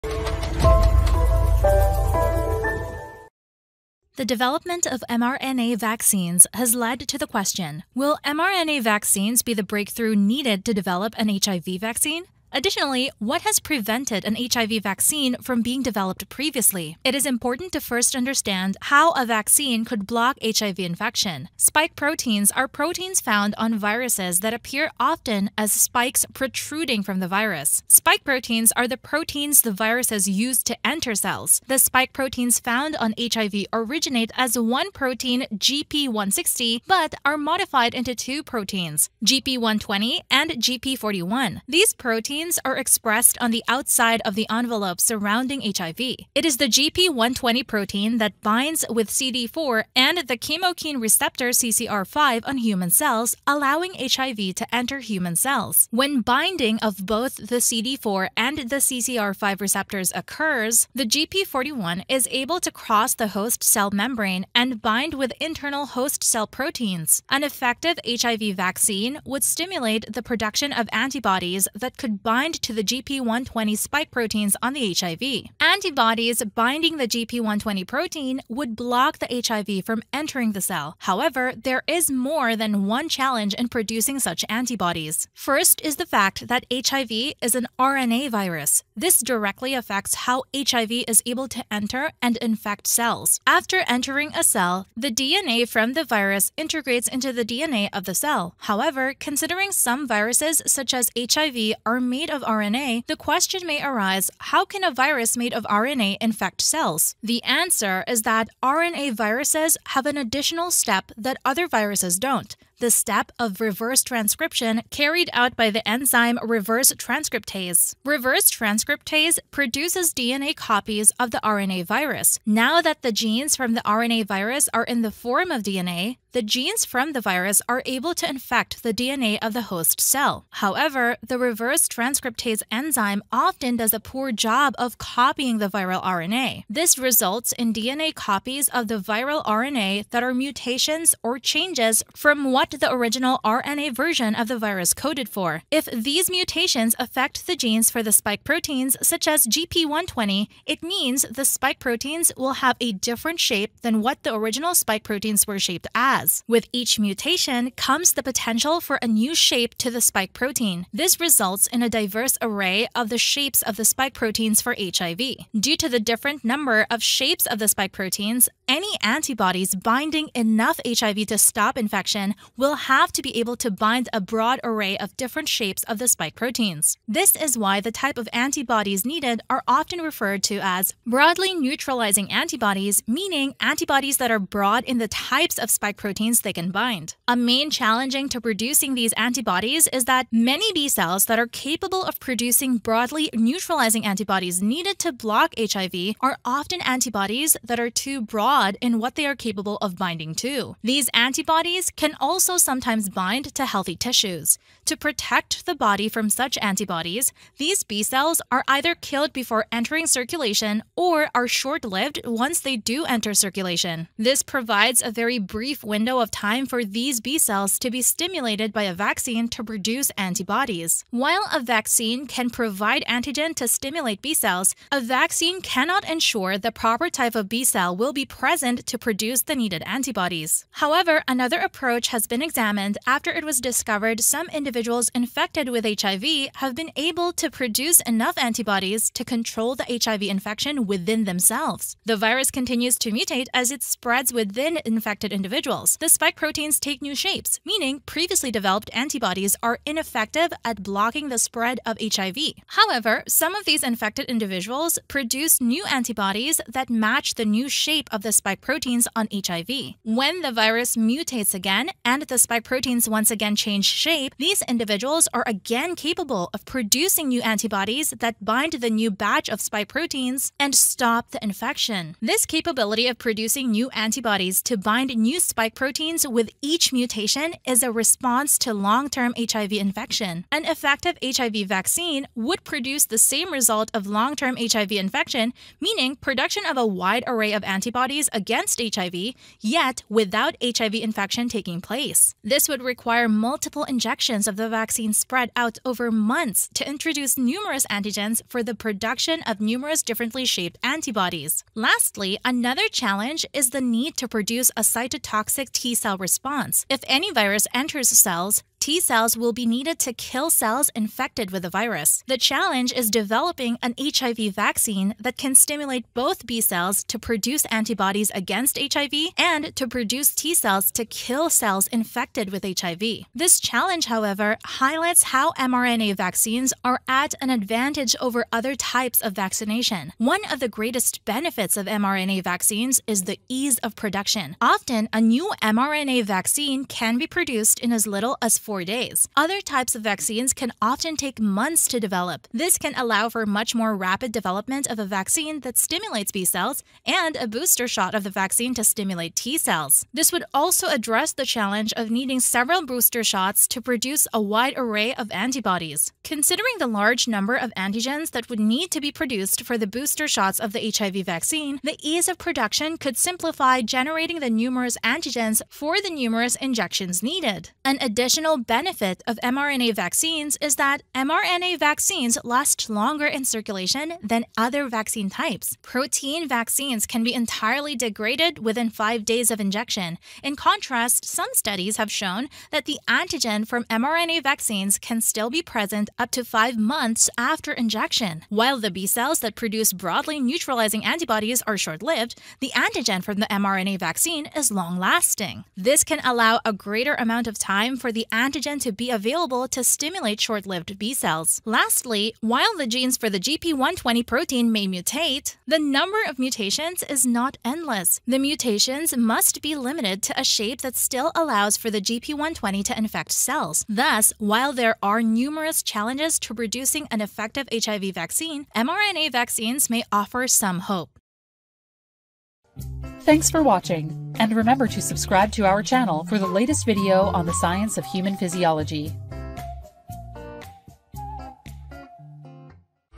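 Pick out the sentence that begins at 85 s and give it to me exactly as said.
First is the fact that HIV is an RNA virus.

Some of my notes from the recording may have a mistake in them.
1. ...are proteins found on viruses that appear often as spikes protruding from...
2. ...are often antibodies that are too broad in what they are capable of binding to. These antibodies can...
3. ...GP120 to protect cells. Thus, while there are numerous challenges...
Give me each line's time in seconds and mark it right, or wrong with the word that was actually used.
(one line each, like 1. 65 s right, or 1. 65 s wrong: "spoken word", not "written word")
1. 22 s right
2. 196 s right
3. 412 s wrong: "infect", not "protect".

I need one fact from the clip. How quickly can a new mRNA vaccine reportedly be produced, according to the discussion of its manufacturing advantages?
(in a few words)
4 days.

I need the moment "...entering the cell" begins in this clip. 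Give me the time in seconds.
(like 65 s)
80 s.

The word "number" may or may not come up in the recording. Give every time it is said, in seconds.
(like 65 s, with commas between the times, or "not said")
166 s, 357 s, 405 s.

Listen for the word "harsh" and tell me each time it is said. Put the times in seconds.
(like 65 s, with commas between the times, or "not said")
not said.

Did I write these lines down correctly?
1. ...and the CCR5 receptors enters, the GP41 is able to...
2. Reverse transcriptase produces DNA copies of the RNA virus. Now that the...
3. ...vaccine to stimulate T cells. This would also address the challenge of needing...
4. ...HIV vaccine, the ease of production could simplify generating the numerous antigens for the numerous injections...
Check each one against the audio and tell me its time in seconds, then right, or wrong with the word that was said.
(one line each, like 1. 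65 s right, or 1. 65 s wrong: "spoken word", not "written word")
1. 58 s wrong: "occurs", not "enters"
2. 118 s right
3. 348 s right
4. 360 s right.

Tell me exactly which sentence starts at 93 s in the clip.
After entering a cell, the DNA from the virus integrates into the DNA of the cell.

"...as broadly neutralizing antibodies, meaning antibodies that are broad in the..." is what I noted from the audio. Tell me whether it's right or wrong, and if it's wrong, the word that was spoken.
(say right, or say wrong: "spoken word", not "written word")
right.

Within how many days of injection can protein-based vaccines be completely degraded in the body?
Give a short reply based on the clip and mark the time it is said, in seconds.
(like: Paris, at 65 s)
5 days, at 378 s.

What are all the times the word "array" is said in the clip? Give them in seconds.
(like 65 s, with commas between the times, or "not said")
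162 s, 174 s, 287 s, 354 s.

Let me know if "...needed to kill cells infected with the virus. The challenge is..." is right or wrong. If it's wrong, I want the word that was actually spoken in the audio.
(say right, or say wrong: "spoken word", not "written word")
right.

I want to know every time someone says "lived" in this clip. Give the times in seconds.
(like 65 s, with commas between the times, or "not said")
211 s, 392 s, 400 s.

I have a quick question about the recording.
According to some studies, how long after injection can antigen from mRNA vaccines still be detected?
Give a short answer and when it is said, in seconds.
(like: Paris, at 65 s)
5 months, at 386 s.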